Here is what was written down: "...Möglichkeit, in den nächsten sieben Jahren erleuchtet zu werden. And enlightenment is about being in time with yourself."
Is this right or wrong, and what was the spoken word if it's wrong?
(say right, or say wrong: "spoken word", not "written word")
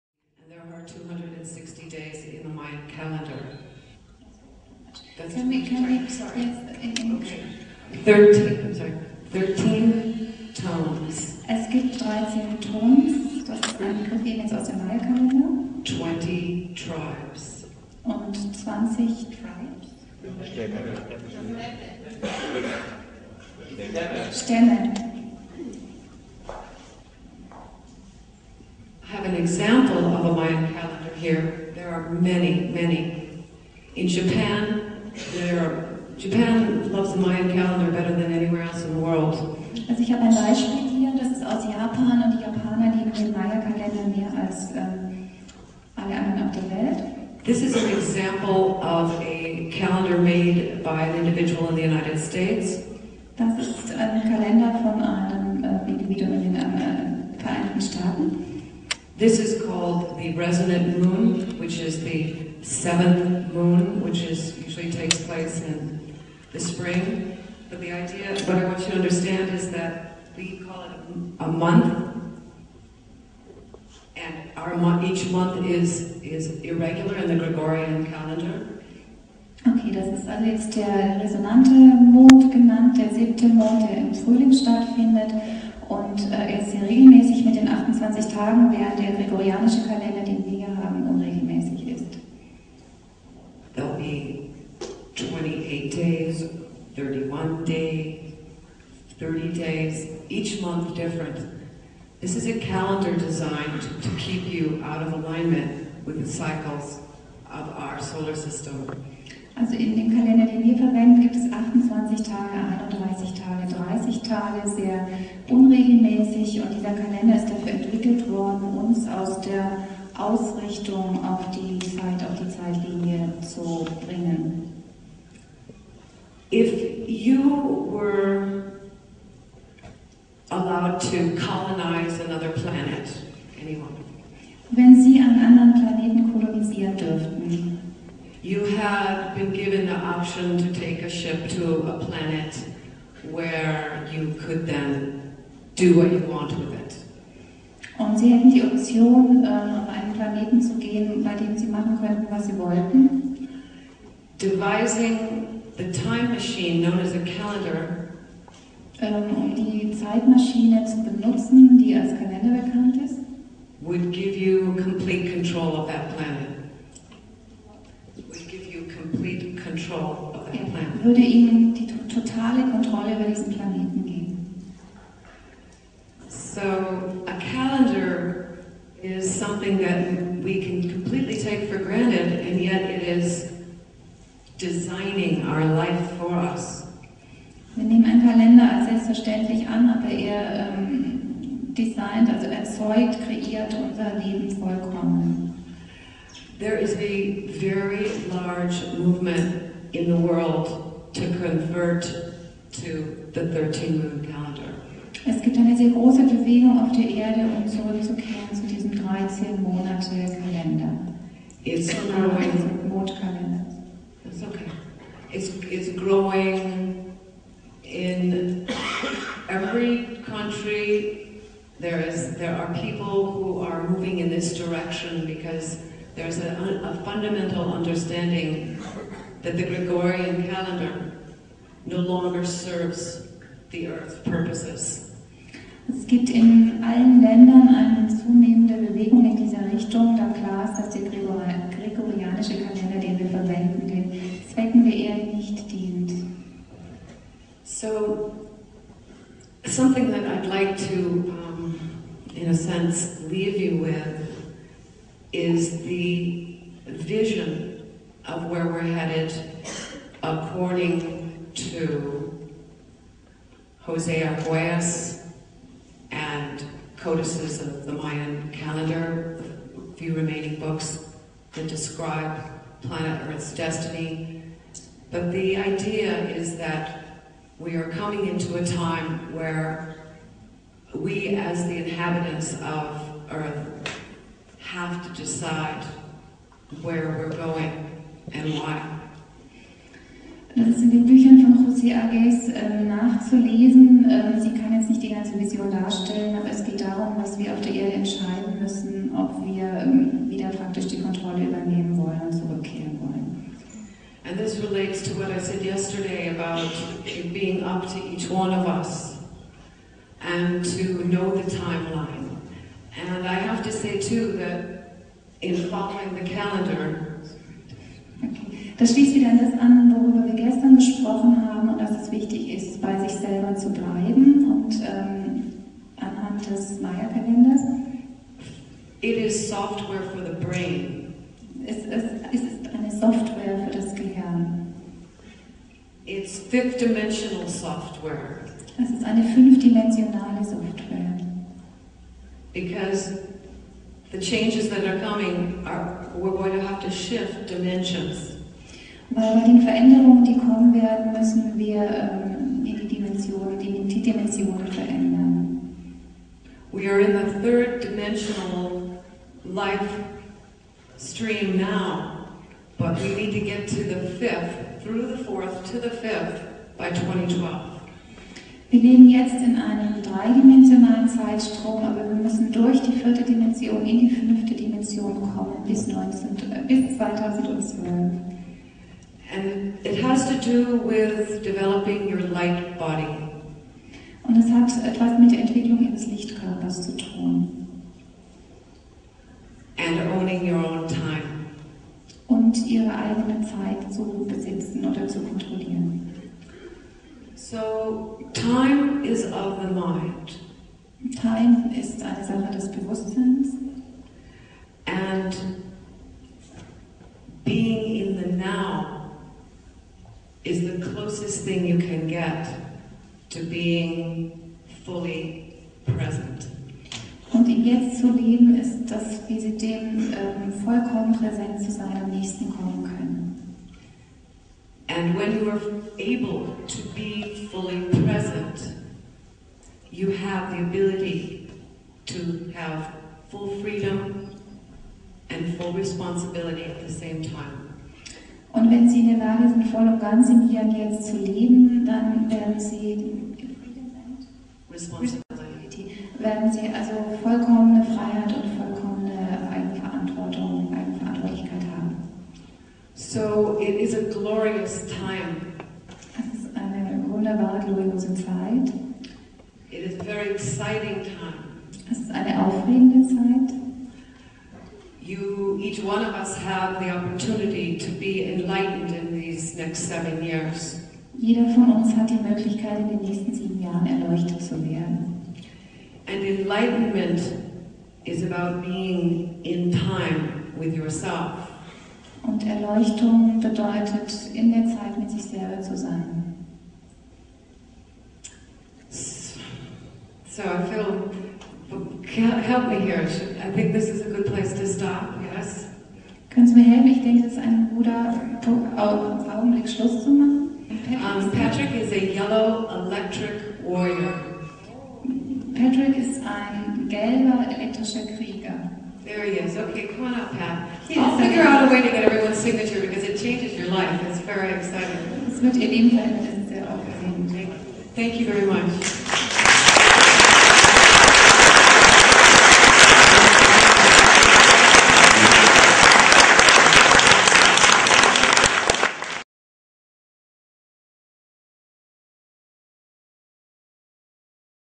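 right.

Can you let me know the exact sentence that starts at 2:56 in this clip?
So a calendar is something that we can completely take for granted and yet it is designing our life for us.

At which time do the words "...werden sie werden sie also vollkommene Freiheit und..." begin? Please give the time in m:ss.
7:22.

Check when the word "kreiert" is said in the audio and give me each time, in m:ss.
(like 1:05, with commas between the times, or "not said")
3:13.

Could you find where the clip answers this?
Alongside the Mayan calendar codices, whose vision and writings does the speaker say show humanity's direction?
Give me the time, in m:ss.
4:23.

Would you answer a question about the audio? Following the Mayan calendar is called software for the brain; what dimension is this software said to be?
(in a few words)
Fifth-dimensional.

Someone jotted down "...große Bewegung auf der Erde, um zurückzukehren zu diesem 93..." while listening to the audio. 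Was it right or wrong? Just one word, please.
wrong.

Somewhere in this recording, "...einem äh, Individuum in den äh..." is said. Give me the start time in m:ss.
0:55.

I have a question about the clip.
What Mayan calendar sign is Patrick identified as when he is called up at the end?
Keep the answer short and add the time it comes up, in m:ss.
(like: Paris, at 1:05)
Yellow electric warrior, at 8:22.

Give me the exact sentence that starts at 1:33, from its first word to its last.
There'll be 28 days, 31 days, 30 days, each month different.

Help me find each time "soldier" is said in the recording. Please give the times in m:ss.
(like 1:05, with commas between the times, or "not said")
not said.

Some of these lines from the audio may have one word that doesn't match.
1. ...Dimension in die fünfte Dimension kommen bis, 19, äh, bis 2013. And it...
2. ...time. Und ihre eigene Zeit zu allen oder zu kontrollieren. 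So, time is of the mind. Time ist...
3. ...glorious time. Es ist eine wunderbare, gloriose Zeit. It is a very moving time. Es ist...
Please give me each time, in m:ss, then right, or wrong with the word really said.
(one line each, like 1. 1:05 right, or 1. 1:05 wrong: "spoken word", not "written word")
1. 6:13 wrong: "2012", not "2013"
2. 6:30 wrong: "besitzen", not "allen"
3. 7:34 wrong: "exciting", not "moving".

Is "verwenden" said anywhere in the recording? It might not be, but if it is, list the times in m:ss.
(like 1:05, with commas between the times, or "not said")
1:50, 4:03.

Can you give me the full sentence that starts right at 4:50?
Das ist in den Büchern von José Agés äh, nachzulesen.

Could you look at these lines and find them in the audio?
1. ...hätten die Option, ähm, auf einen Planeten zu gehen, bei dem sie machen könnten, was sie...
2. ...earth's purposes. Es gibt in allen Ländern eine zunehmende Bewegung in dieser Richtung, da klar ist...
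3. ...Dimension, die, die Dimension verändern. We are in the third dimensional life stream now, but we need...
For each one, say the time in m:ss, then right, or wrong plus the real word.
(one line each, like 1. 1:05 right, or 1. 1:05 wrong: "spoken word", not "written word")
1. 2:28 right
2. 3:53 right
3. 5:52 right.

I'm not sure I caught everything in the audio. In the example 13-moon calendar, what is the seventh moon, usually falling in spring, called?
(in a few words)
Resonant moon.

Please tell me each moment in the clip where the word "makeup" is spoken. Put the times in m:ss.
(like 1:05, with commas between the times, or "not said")
not said.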